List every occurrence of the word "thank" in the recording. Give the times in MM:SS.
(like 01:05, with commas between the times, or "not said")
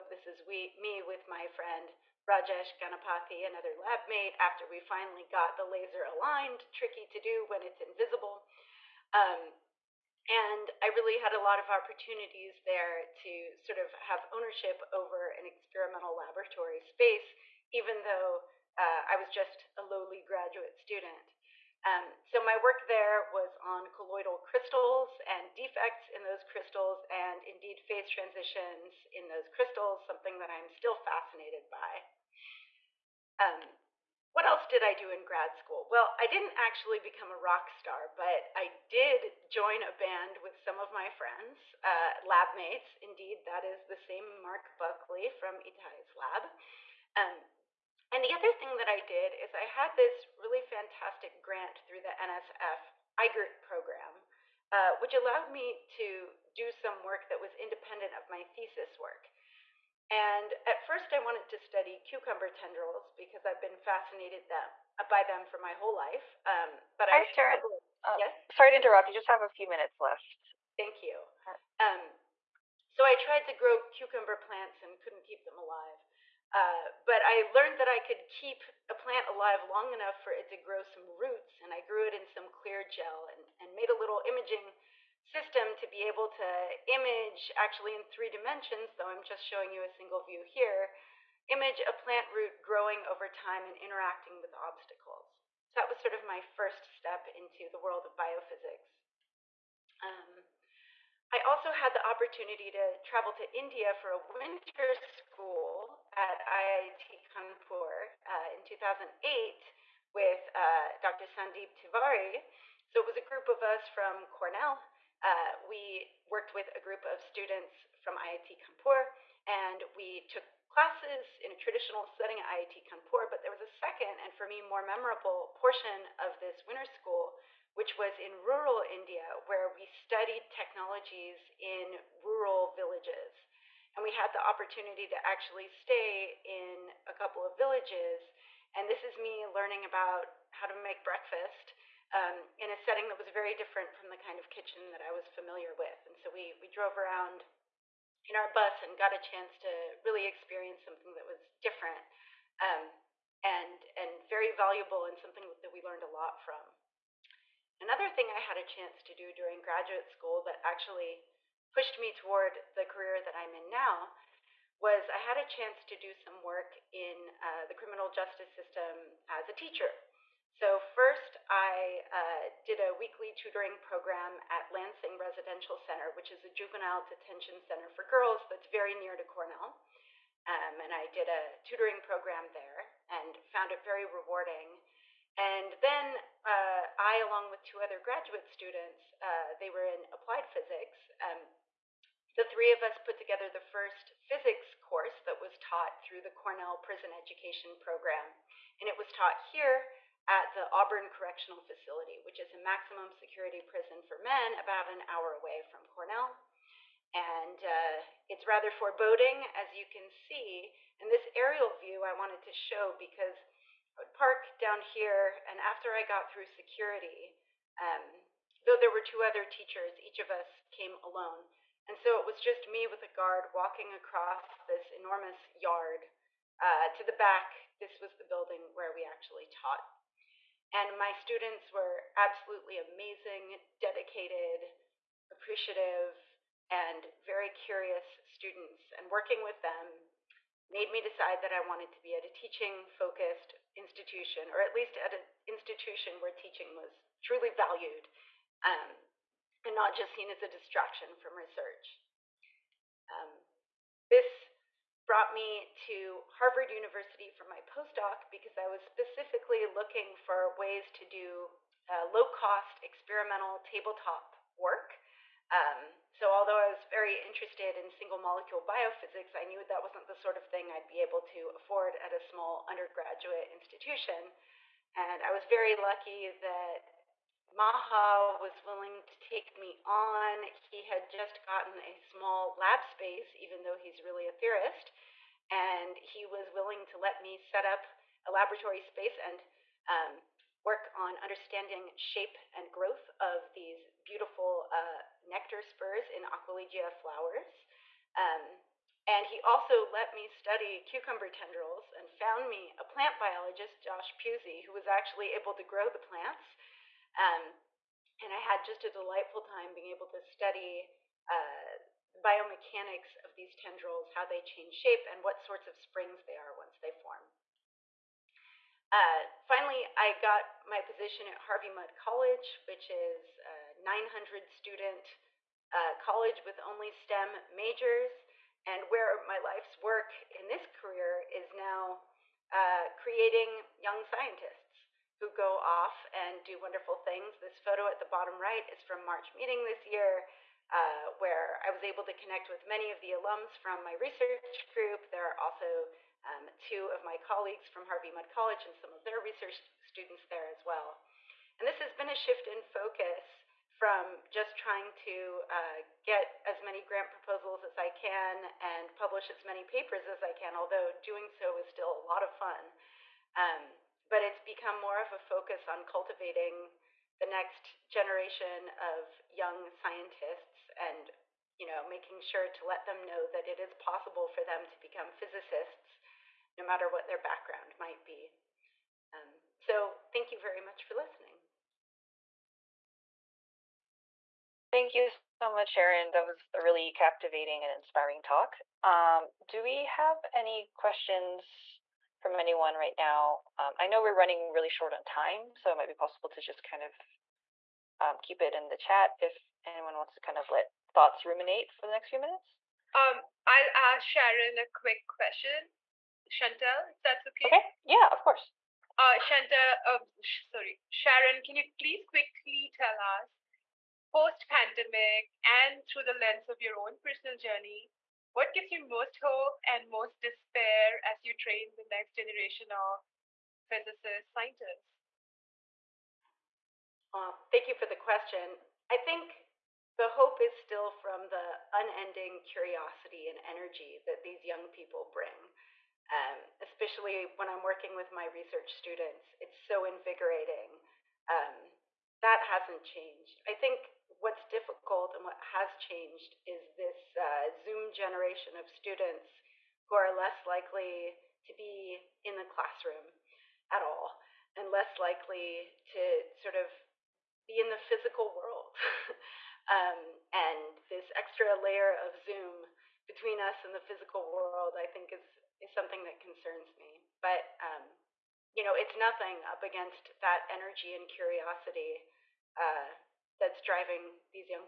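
01:10, 06:20, 06:24, 07:07.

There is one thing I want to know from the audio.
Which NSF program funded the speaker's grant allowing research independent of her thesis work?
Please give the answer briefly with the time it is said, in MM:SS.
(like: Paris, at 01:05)
IGERT, at 00:53.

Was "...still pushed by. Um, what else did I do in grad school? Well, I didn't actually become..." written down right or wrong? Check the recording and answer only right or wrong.
wrong.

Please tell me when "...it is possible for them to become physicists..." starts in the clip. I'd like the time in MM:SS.
06:13.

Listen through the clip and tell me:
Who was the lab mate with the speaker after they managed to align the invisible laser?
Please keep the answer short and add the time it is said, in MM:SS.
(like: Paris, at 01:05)
Rajesh Ganapathy, at 00:02.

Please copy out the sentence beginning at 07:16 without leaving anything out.
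Um, especially when I'm working with my research students, it's so invigorating.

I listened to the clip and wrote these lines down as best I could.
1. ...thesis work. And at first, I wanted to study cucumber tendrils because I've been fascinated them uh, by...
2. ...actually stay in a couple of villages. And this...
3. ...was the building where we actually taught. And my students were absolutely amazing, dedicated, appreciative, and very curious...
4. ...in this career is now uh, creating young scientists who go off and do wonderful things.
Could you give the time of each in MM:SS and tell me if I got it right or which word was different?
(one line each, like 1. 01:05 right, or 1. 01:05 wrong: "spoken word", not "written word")
1. 00:58 right
2. 02:15 right
3. 03:47 right
4. 05:30 right.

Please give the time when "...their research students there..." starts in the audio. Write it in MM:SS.
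05:49.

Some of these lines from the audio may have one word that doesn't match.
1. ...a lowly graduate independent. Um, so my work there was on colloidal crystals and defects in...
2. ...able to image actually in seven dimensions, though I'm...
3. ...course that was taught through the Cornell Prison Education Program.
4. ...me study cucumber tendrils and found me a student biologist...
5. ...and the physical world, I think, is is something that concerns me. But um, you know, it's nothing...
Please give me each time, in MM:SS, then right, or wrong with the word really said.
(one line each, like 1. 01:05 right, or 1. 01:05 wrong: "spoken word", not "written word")
1. 00:19 wrong: "student", not "independent"
2. 01:26 wrong: "three", not "seven"
3. 03:14 right
4. 05:00 wrong: "plant", not "student"
5. 07:43 right.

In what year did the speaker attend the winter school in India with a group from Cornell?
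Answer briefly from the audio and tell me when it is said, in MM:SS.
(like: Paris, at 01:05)
2008, at 01:48.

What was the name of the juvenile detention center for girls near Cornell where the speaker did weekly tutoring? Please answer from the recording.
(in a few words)
Lansing Residential Center.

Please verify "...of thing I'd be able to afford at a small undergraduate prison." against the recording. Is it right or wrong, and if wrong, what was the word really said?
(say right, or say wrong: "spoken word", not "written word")
wrong: "institution", not "prison".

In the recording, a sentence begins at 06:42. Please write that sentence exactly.
Um, I'll ask Sharon a quick question.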